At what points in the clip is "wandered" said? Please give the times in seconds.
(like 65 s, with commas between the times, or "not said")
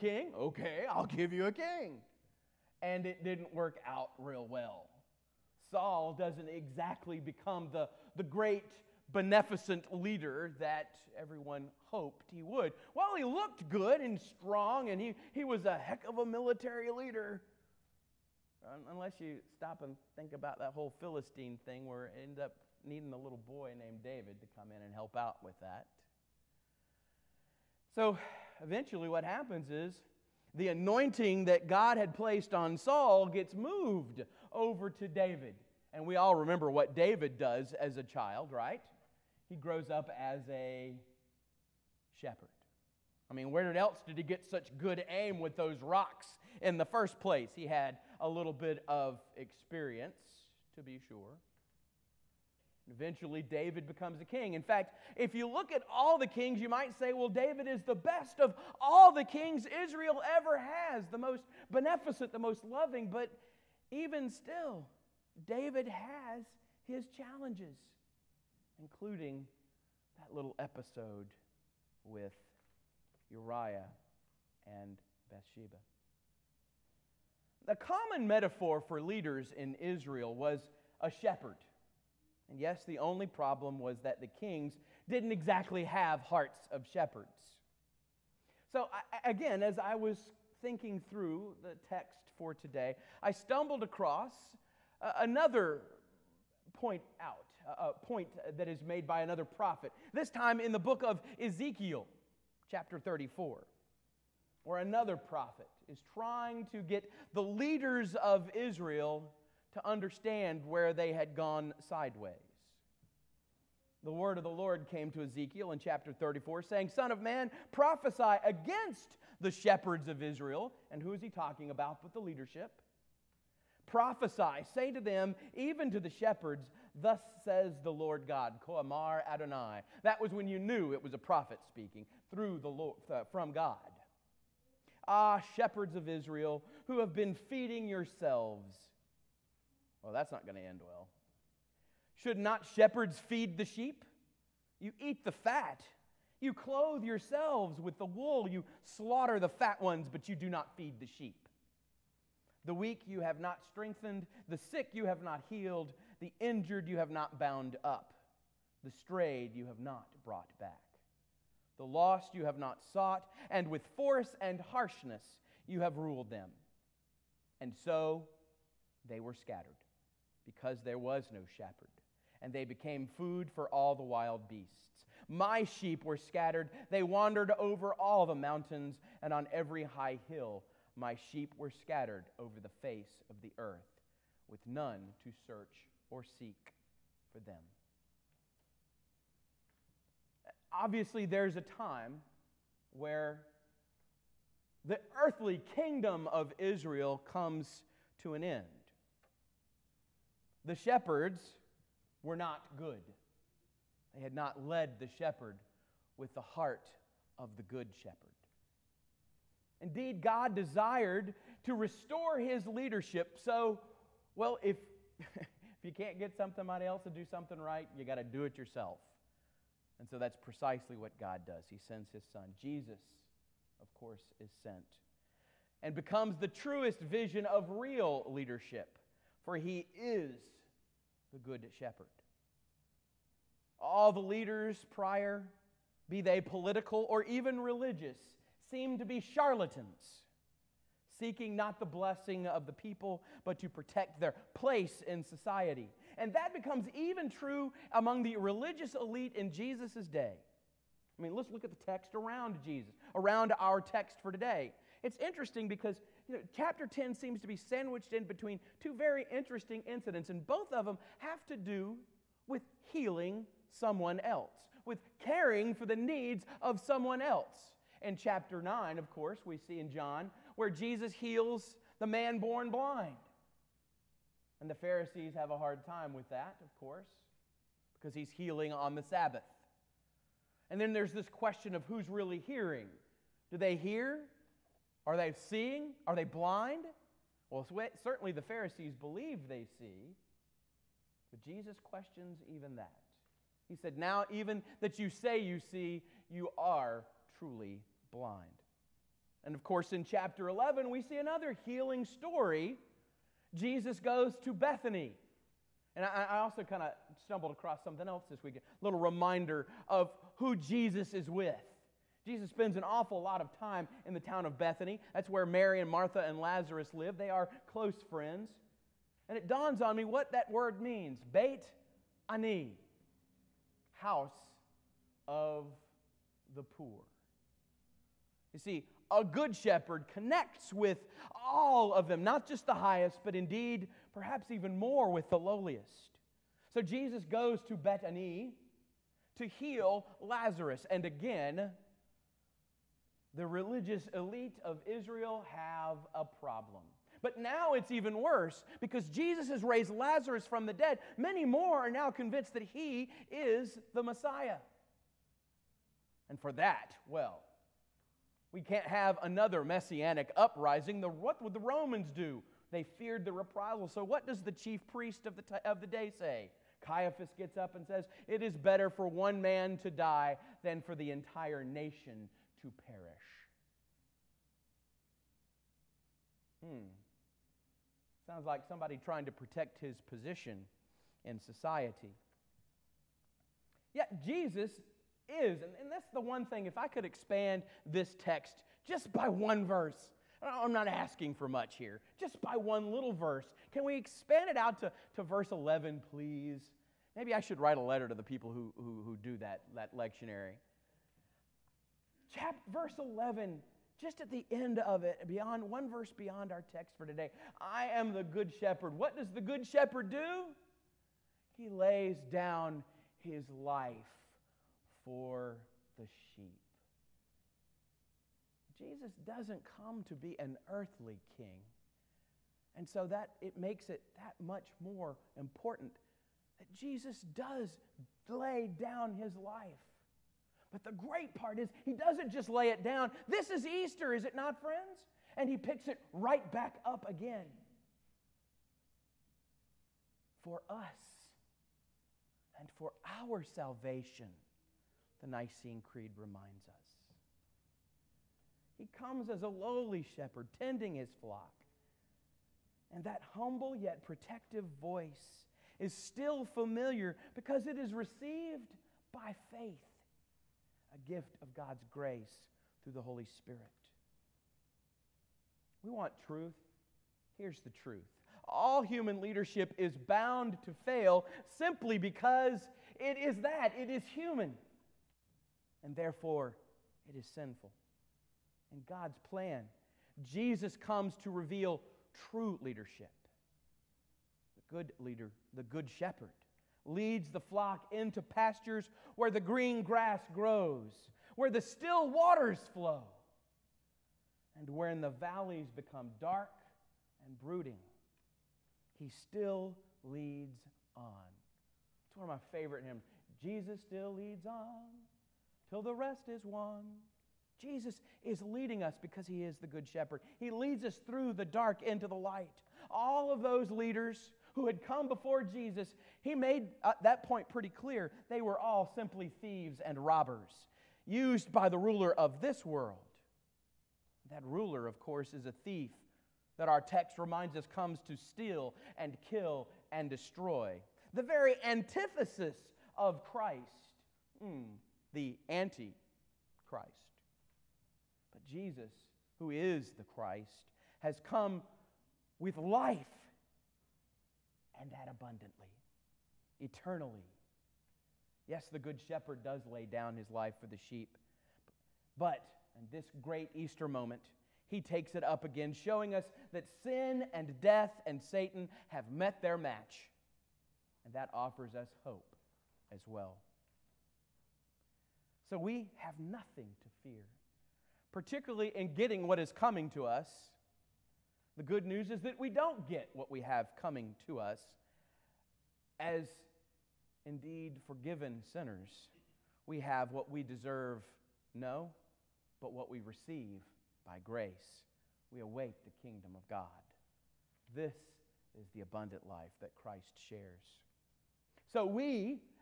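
177 s.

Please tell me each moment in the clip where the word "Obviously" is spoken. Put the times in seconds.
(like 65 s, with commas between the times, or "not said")
190 s.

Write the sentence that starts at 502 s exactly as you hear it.
It's one of my favorite hymns.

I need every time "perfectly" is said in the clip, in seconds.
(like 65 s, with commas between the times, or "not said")
not said.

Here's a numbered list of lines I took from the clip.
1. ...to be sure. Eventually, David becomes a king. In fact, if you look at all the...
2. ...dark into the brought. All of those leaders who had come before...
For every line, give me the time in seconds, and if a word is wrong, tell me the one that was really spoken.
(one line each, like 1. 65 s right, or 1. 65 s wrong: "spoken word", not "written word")
1. 50 s right
2. 511 s wrong: "light", not "brought".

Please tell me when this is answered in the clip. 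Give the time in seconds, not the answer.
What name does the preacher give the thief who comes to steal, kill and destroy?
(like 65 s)
535 s.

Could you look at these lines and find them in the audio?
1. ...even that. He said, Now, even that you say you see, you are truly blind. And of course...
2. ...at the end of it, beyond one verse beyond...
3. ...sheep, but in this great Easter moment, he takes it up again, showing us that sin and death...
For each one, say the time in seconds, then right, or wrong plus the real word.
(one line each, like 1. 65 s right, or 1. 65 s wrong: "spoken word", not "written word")
1. 292 s right
2. 404 s right
3. 550 s right.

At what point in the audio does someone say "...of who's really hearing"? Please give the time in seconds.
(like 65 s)
281 s.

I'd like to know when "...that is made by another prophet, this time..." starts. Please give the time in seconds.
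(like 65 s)
98 s.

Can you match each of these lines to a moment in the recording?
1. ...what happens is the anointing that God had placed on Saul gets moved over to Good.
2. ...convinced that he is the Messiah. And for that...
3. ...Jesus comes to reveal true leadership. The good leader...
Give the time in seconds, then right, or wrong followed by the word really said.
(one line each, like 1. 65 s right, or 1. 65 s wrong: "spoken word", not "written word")
1. 29 s wrong: "David", not "Good"
2. 352 s right
3. 480 s right.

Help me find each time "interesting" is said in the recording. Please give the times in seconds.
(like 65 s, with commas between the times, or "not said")
255 s, 259 s.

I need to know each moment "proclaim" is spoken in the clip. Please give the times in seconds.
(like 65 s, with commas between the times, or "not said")
not said.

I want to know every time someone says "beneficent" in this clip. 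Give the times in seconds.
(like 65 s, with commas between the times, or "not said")
9 s, 61 s.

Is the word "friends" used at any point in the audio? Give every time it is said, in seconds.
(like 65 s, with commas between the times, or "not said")
318 s, 434 s.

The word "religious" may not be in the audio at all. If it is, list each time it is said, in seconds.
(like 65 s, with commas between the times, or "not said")
237 s, 248 s, 343 s.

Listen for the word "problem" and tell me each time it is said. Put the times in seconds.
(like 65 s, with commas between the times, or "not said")
83 s, 346 s.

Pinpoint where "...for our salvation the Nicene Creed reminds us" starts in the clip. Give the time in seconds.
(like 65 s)
442 s.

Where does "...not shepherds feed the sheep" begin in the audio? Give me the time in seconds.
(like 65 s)
142 s.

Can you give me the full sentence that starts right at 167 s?
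And so they were scattered, because there was no shepherd, and they became food for all the wild beasts.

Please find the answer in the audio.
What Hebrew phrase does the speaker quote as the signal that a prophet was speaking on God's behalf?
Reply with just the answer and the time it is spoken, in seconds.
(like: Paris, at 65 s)
Koamar Adonai, at 128 s.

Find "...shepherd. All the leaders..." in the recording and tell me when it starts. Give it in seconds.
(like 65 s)
231 s.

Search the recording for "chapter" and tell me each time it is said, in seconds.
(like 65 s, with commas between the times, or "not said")
102 s, 115 s, 256 s, 268 s, 300 s, 402 s.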